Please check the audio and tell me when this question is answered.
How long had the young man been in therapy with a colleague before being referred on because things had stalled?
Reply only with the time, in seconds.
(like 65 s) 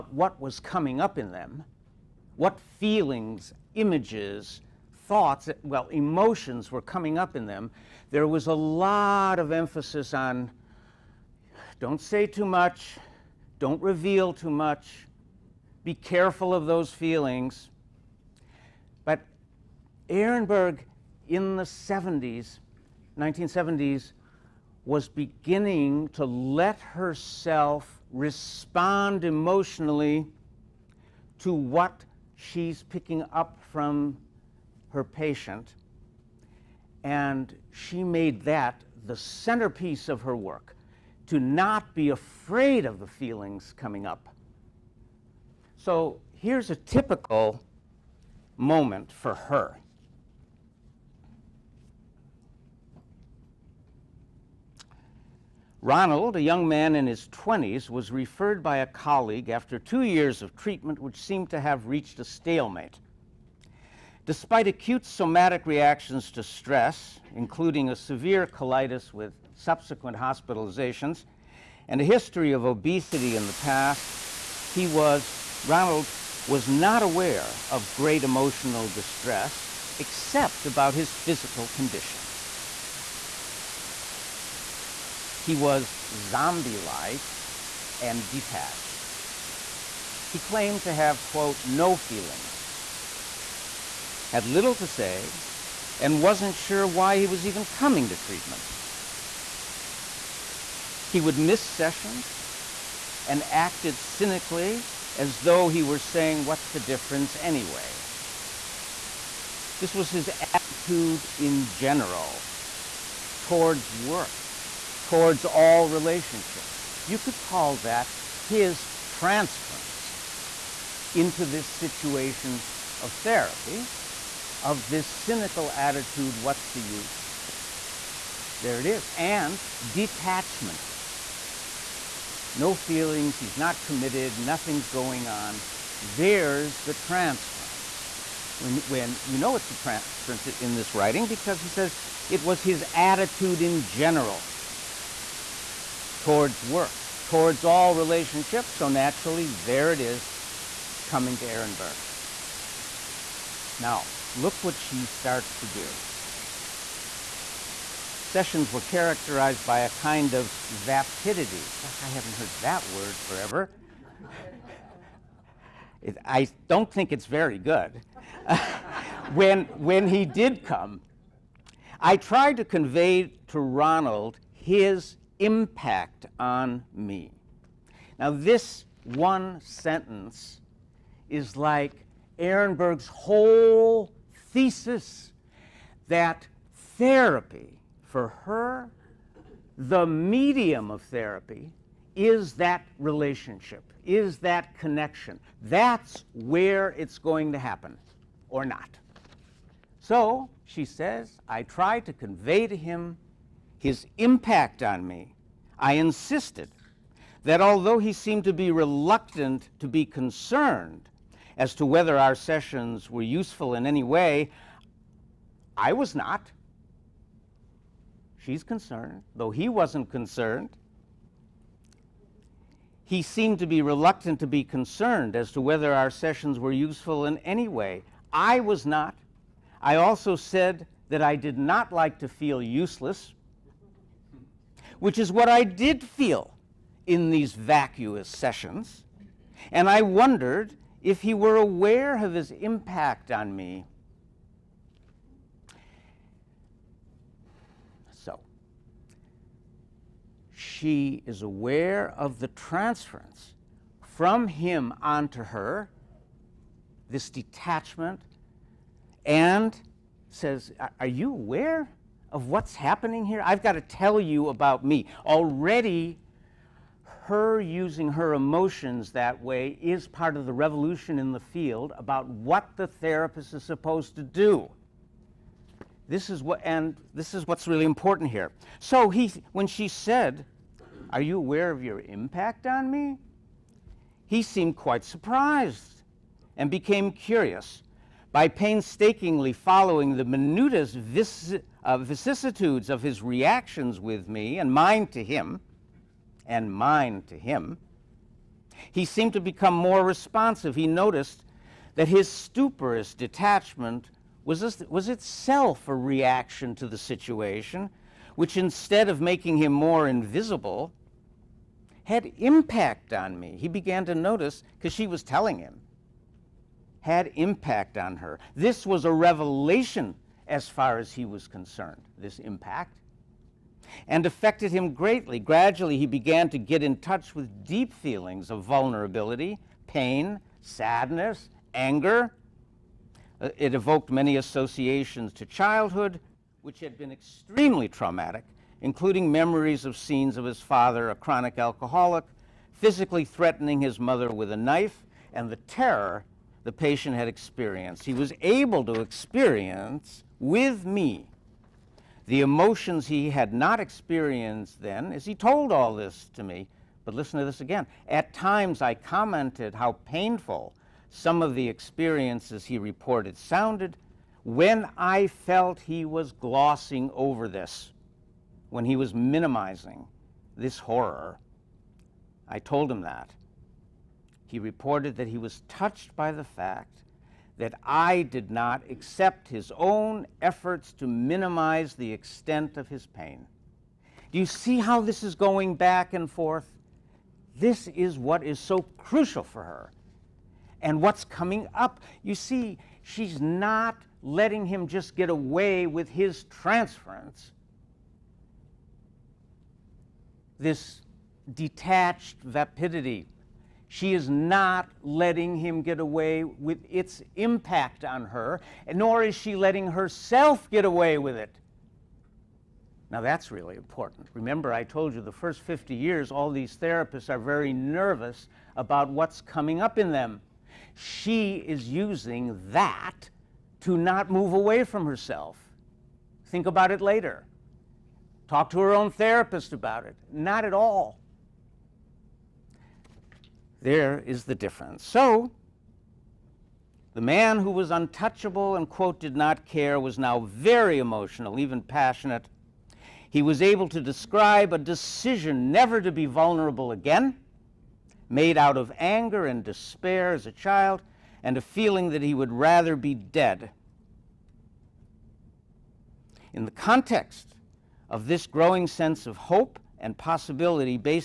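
59 s.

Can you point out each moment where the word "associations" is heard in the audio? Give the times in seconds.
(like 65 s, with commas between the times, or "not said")
334 s.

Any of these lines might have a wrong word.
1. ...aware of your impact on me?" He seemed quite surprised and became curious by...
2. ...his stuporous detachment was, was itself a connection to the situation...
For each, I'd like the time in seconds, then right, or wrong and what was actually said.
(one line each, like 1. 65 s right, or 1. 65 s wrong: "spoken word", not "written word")
1. 281 s right
2. 302 s wrong: "reaction", not "connection".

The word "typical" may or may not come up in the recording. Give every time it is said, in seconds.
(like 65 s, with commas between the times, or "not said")
46 s.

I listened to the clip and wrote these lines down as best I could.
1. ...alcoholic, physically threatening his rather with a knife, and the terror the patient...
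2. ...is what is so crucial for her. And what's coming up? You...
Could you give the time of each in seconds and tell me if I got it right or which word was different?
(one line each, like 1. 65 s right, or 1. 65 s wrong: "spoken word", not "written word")
1. 341 s wrong: "mother", not "rather"
2. 387 s right.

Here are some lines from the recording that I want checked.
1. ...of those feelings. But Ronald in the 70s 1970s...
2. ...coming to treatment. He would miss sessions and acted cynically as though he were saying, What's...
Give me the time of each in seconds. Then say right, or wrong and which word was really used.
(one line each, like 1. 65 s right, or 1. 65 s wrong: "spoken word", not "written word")
1. 16 s wrong: "Ehrenberg", not "Ronald"
2. 97 s right.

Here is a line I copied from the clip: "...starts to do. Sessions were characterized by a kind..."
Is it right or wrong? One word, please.
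right.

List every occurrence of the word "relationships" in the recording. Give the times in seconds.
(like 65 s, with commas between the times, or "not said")
115 s, 147 s, 192 s.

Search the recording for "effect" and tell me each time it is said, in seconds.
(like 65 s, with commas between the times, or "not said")
not said.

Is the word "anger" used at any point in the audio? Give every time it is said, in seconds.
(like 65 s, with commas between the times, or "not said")
331 s, 448 s.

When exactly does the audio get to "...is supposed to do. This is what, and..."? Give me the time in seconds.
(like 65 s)
273 s.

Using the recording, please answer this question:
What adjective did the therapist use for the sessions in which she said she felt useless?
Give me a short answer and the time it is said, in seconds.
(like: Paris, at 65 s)
vacuous, at 237 s.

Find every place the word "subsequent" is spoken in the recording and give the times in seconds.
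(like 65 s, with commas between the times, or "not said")
69 s.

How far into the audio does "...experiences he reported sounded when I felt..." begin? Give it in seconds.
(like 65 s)
361 s.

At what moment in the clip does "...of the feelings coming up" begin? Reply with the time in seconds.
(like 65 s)
42 s.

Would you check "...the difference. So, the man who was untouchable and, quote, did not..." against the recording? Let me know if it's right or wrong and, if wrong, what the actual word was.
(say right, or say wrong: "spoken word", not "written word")
right.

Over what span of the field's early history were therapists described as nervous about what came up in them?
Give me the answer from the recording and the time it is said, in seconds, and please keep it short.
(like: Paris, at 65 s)
first 50 years, at 415 s.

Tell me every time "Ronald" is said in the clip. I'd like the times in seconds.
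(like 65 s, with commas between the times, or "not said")
55 s, 75 s, 173 s.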